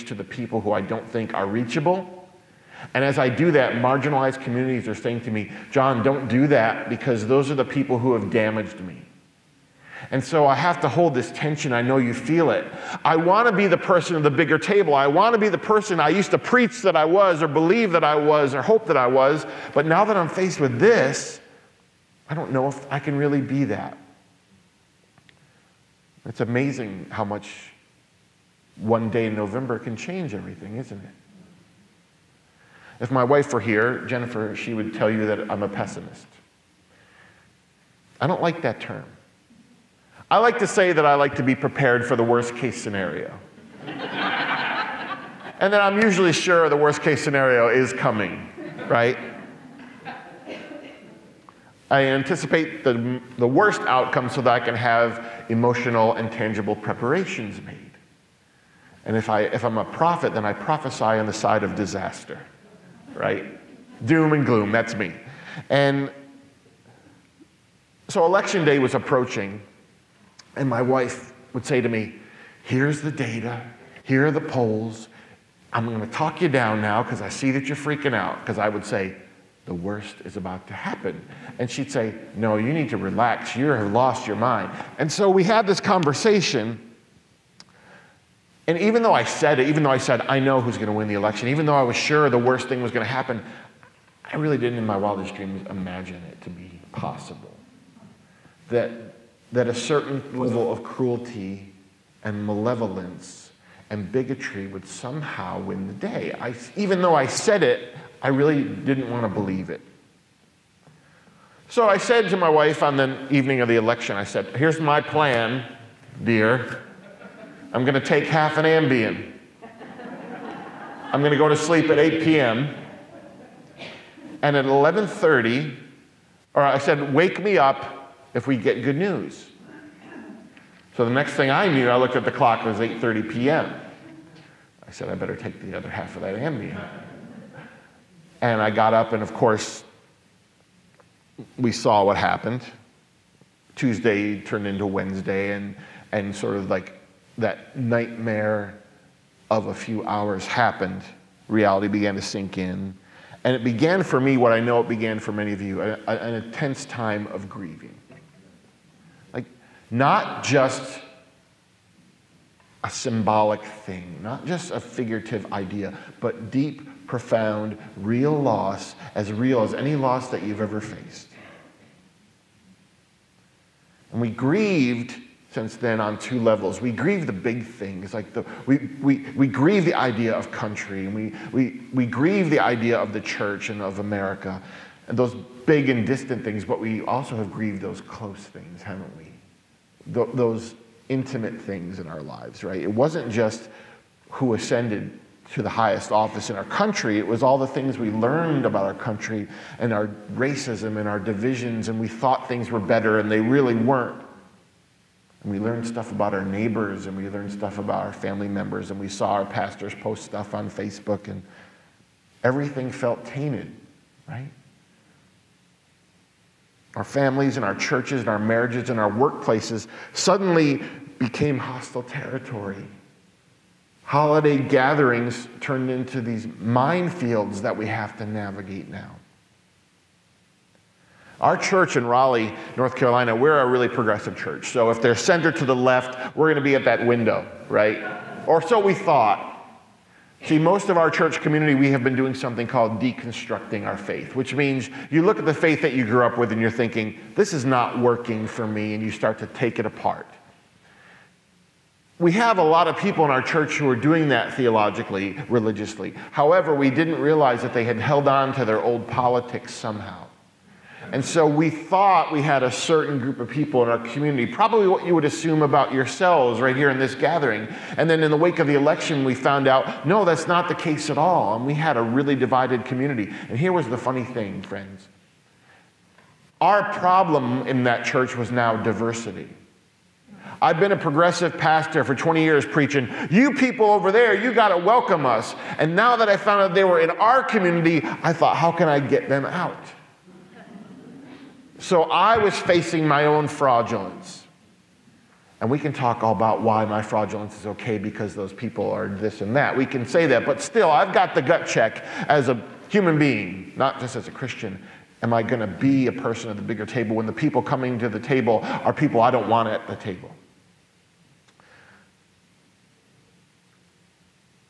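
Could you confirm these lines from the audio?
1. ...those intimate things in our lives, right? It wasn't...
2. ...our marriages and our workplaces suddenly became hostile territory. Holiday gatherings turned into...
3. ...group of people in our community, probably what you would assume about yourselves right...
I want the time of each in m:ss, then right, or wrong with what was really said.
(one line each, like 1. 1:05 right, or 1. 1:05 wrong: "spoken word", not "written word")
1. 3:10 right
2. 3:38 right
3. 4:23 right.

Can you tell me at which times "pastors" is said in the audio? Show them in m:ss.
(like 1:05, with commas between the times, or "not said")
3:29, 4:41.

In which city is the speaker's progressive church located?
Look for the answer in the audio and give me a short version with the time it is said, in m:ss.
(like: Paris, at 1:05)
Raleigh, at 3:52.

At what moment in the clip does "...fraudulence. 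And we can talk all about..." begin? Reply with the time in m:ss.
4:53.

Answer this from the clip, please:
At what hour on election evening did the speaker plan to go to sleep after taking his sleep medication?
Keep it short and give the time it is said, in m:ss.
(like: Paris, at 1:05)
8 p.m., at 2:01.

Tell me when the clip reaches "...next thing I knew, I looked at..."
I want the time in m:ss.
2:11.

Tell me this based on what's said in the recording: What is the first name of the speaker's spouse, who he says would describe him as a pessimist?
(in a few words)
Jennifer.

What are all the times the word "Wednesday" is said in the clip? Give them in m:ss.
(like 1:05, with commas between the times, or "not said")
2:24.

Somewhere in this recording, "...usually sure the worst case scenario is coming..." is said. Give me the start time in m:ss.
0:46.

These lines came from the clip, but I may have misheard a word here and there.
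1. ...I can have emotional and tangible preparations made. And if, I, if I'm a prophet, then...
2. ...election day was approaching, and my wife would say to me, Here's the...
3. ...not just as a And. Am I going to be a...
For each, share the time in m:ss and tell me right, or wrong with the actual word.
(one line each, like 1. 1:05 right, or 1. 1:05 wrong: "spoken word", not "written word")
1. 0:54 right
2. 1:08 right
3. 5:03 wrong: "Christian", not "And".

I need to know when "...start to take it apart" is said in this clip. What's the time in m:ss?
4:09.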